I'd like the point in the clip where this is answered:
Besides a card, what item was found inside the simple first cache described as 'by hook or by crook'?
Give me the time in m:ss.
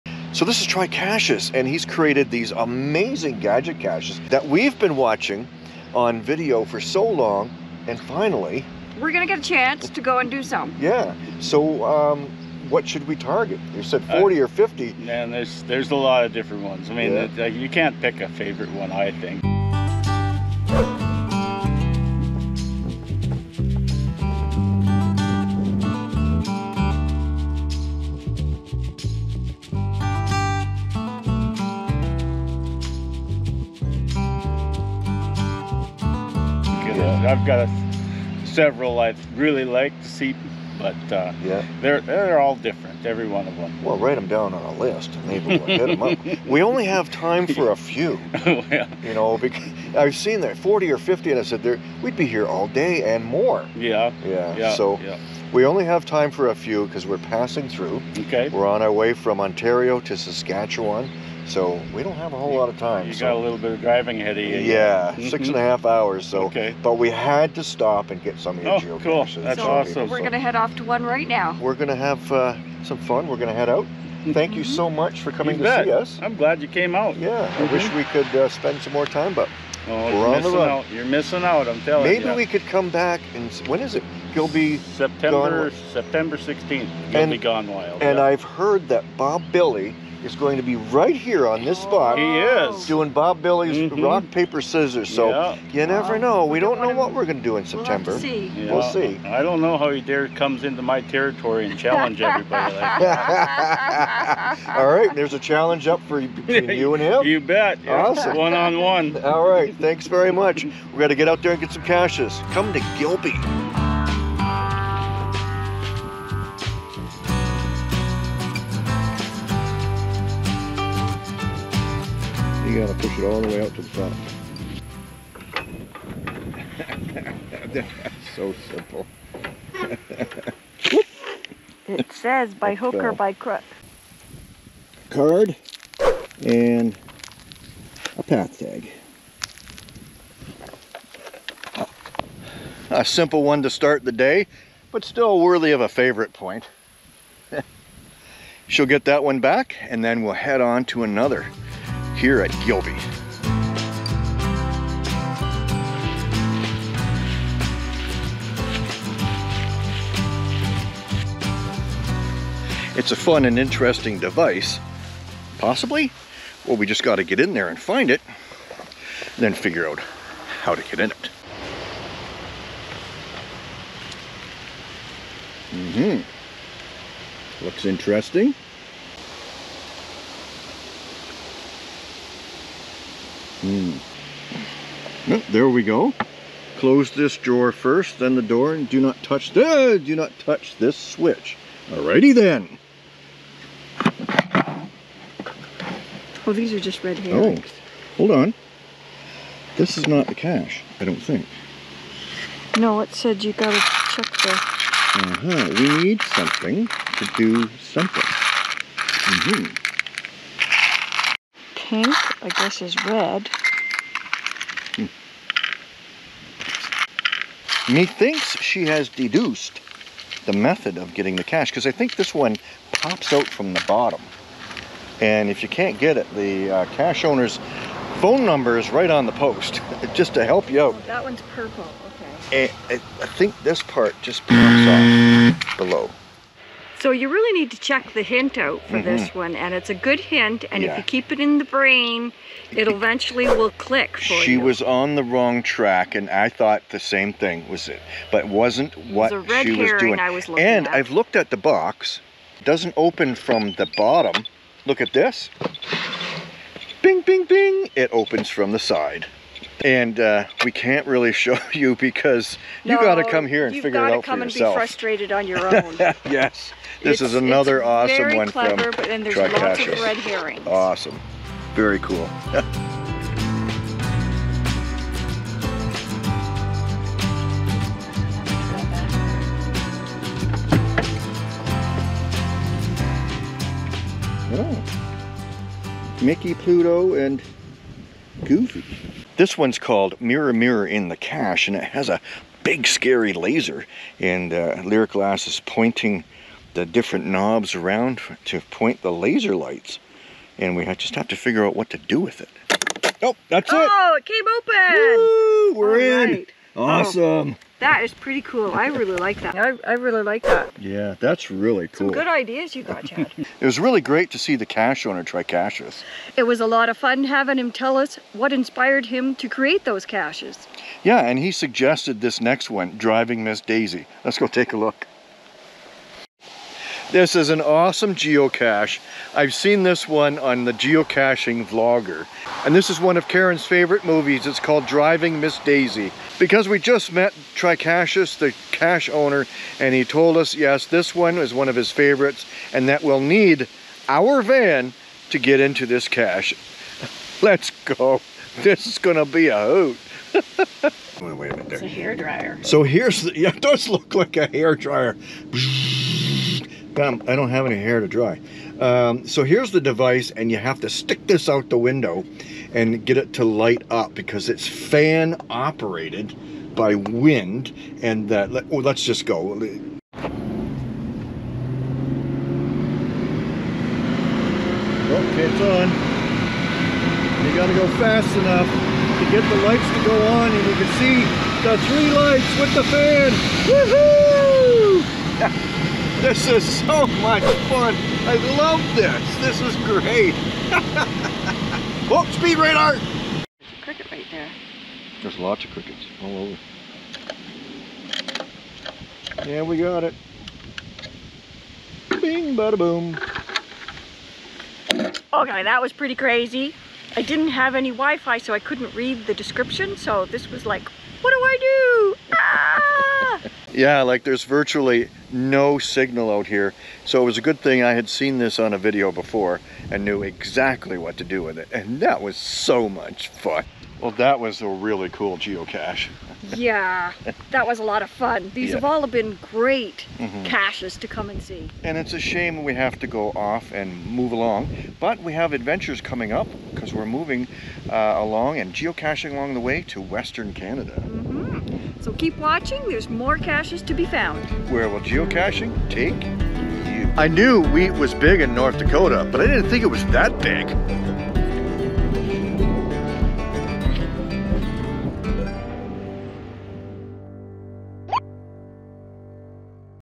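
2:18.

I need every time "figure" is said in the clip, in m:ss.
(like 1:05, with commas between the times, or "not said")
2:49, 4:23, 5:01.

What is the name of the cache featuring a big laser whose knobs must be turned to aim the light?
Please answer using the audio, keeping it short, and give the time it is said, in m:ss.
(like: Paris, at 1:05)
Mirror Mirror in the Cache, at 4:50.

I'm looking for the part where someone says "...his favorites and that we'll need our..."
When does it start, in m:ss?
5:41.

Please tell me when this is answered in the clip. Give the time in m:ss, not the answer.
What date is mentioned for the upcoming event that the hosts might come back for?
1:25.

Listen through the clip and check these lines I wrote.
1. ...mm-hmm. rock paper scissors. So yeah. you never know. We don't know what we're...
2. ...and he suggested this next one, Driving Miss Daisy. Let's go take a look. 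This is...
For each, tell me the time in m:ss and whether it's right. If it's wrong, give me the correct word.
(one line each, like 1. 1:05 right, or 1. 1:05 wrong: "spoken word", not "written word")
1. 1:33 right
2. 5:21 right.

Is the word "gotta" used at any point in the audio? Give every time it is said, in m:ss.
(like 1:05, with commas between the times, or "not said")
3:23, 6:17.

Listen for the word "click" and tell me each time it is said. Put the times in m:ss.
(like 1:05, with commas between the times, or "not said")
4:03.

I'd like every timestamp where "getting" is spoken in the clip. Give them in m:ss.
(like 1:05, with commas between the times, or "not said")
3:41.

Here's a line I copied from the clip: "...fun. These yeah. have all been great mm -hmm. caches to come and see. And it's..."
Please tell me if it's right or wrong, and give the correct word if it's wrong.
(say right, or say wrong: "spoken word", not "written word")
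right.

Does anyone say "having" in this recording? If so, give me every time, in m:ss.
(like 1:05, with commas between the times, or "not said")
5:17.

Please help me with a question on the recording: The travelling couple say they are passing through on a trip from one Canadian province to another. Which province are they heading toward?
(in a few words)
Saskatchewan.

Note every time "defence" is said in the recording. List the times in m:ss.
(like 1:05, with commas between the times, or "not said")
not said.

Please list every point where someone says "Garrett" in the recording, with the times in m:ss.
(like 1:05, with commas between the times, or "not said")
not said.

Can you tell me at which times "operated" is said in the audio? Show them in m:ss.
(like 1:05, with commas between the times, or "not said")
6:05.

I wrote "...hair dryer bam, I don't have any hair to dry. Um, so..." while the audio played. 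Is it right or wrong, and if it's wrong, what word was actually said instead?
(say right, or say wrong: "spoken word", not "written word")
right.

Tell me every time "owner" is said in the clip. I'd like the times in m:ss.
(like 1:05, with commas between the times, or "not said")
3:47, 5:15, 5:39.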